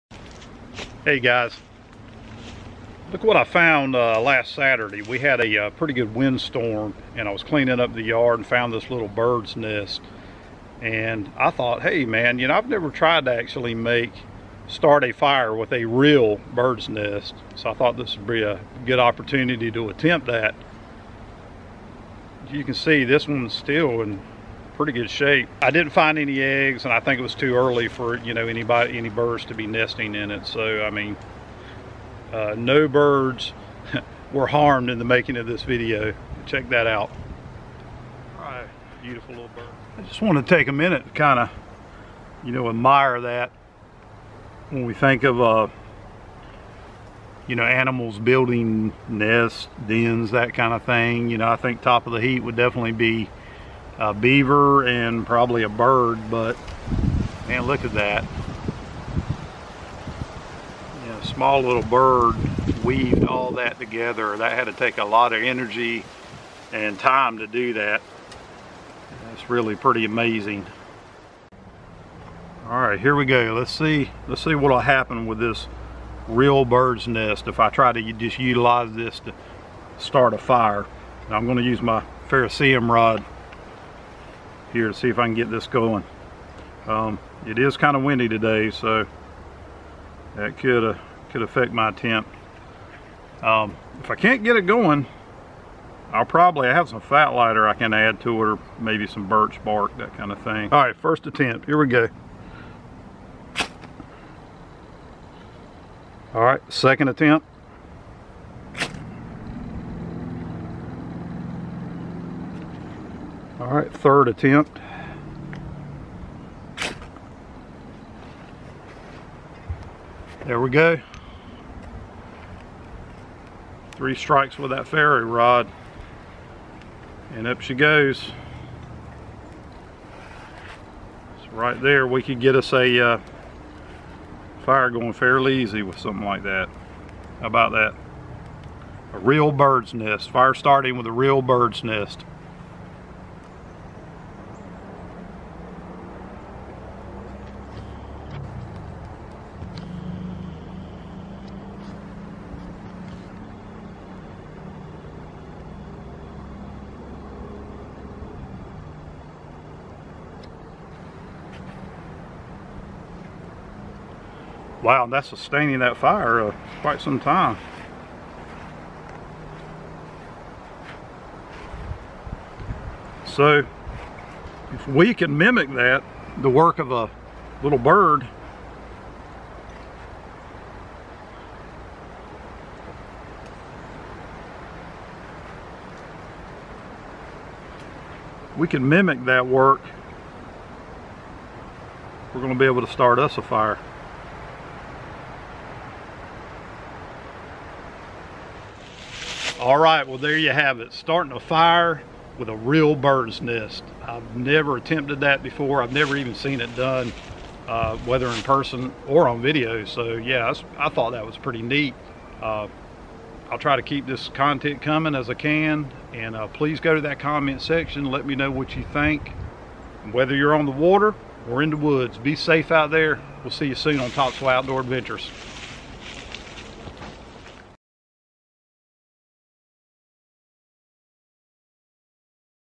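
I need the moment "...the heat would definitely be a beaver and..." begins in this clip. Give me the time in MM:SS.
00:52.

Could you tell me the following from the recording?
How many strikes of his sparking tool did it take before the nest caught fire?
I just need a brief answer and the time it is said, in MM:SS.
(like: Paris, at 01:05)
3, at 02:03.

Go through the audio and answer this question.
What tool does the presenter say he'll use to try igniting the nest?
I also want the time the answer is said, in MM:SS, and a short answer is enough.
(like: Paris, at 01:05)
ferrocerium rod, at 01:22.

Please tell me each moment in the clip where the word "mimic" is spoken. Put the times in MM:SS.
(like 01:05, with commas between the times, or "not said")
02:55, 03:08.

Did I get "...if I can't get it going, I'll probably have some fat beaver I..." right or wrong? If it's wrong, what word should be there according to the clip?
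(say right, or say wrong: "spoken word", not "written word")
wrong: "lighter", not "beaver".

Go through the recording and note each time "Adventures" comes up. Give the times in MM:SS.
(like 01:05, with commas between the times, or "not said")
03:44.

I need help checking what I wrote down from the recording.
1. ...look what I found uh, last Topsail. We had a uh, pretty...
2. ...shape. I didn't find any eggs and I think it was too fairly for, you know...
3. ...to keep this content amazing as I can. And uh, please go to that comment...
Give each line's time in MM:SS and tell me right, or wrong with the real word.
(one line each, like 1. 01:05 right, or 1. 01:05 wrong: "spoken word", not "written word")
1. 00:03 wrong: "Saturday", not "Topsail"
2. 00:25 wrong: "early", not "fairly"
3. 03:33 wrong: "coming", not "amazing".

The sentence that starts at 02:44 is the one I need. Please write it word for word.
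Wow, that's sustaining that fire uh, quite some time.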